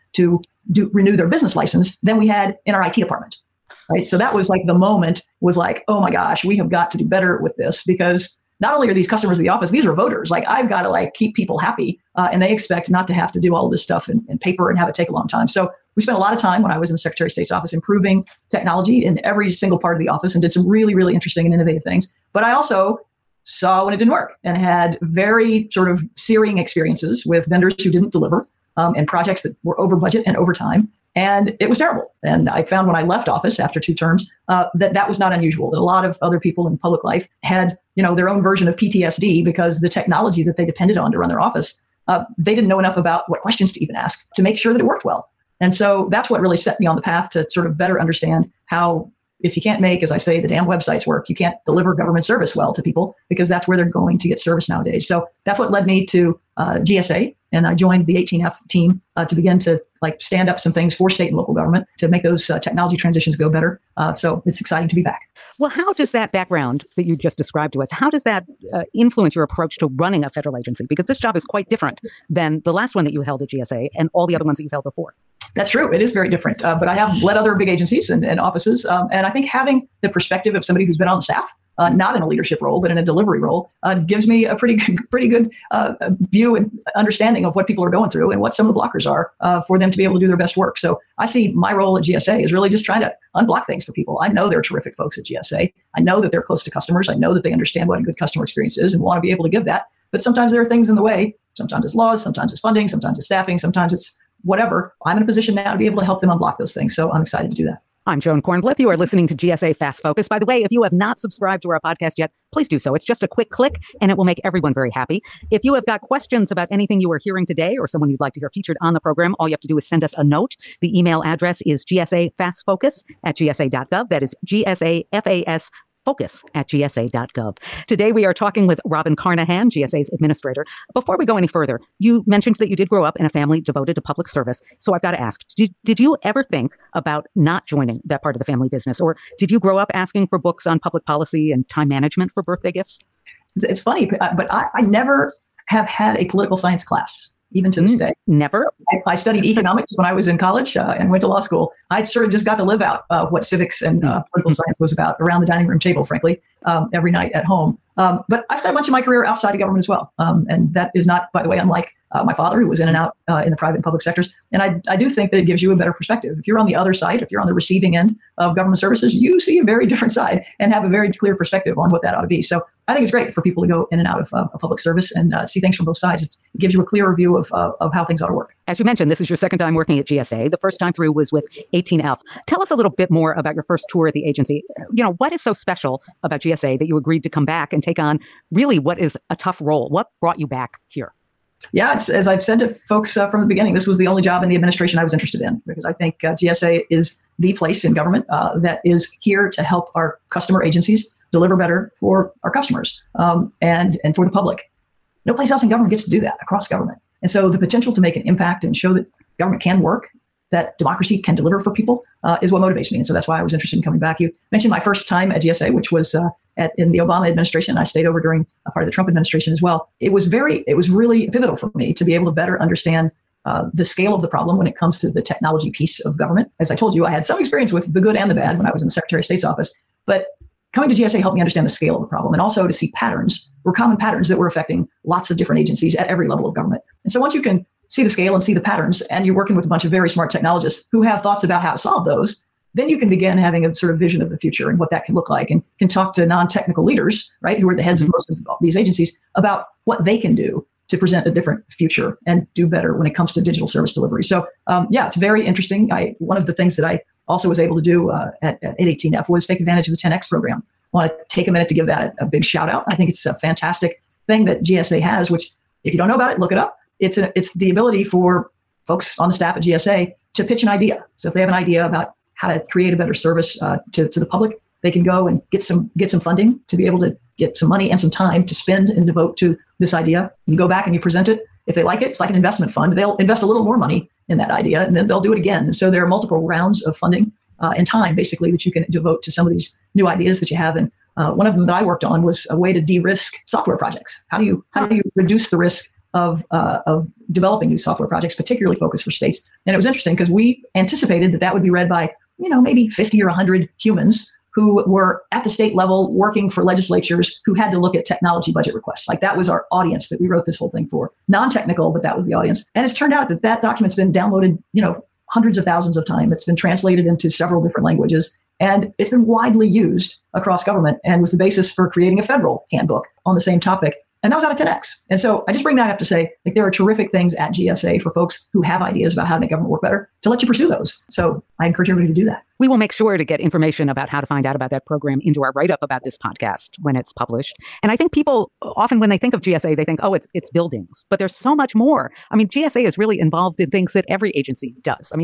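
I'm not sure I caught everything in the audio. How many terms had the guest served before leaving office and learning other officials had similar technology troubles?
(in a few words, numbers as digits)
2.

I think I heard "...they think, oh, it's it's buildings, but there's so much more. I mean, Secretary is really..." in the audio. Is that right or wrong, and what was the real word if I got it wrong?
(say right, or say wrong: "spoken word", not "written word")
wrong: "GSA", not "Secretary".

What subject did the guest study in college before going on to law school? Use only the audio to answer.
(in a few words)
Economics.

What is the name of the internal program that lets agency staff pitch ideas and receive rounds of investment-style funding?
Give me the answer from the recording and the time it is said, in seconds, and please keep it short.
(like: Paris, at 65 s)
10X, at 259 s.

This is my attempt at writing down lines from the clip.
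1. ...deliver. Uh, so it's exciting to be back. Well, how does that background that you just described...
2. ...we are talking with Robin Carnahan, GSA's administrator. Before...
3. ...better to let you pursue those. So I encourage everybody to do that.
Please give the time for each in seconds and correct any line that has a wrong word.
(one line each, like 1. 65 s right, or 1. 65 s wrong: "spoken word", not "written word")
1. 63 s wrong: "better", not "deliver"
2. 128 s right
3. 329 s right.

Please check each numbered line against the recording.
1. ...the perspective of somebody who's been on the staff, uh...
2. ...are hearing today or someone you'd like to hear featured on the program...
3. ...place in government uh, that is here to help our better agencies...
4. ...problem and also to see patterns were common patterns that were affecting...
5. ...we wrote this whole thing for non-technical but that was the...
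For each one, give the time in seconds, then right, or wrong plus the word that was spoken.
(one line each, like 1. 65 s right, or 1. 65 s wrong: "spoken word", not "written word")
1. 80 s right
2. 117 s right
3. 197 s wrong: "customer", not "better"
4. 232 s right
5. 310 s right.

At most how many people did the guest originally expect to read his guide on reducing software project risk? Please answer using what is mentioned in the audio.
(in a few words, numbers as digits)
100.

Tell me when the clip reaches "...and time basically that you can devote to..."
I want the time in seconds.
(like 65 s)
287 s.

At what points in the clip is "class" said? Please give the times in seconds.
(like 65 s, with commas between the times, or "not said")
146 s.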